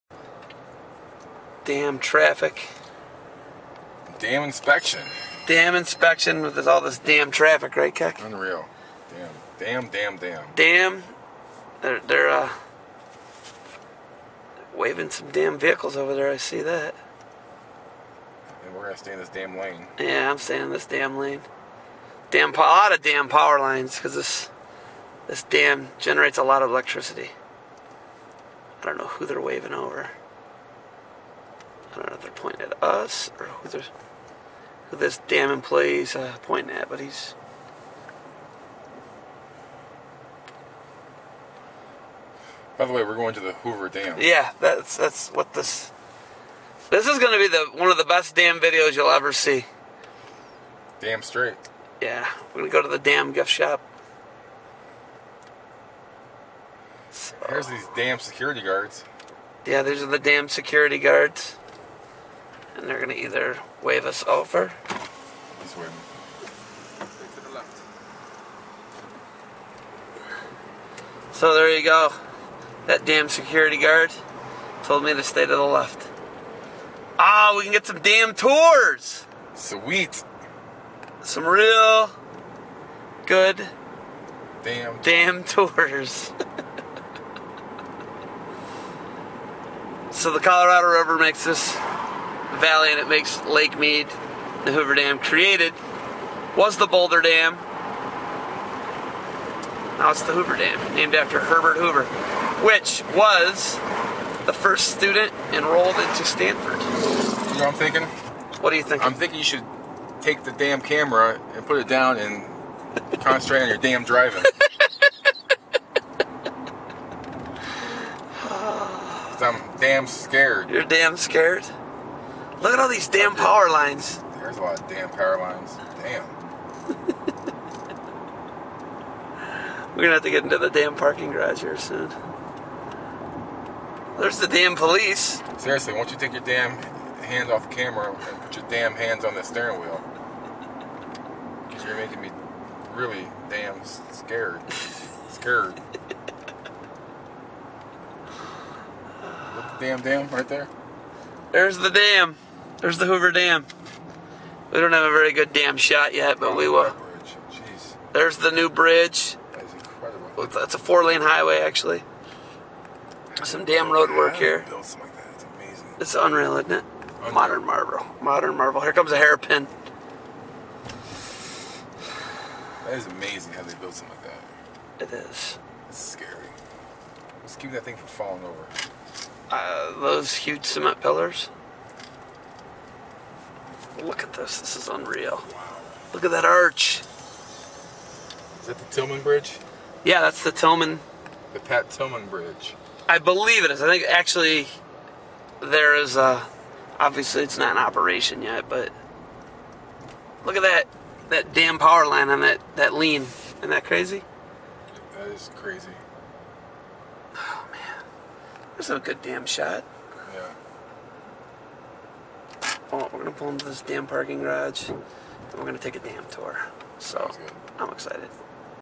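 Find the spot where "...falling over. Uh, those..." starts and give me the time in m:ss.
2:58.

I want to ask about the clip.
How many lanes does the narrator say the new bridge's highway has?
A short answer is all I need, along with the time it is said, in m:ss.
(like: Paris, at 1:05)
4, at 2:40.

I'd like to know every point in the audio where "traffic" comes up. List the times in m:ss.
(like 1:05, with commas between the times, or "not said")
0:01, 0:07.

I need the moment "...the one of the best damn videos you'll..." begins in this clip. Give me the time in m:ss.
0:47.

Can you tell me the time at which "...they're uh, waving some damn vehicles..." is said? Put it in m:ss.
0:11.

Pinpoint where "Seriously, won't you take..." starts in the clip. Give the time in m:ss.
2:15.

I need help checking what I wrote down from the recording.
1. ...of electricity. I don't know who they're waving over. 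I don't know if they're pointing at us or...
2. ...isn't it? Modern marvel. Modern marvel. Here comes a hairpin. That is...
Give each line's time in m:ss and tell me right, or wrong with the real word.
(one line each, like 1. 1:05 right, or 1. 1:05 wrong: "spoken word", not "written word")
1. 0:26 right
2. 2:46 right.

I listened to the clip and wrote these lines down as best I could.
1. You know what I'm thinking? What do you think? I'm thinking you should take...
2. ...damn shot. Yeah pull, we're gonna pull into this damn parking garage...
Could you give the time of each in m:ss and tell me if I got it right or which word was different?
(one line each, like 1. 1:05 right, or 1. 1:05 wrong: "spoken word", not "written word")
1. 1:46 right
2. 3:29 right.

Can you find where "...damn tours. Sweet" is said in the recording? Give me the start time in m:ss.
1:18.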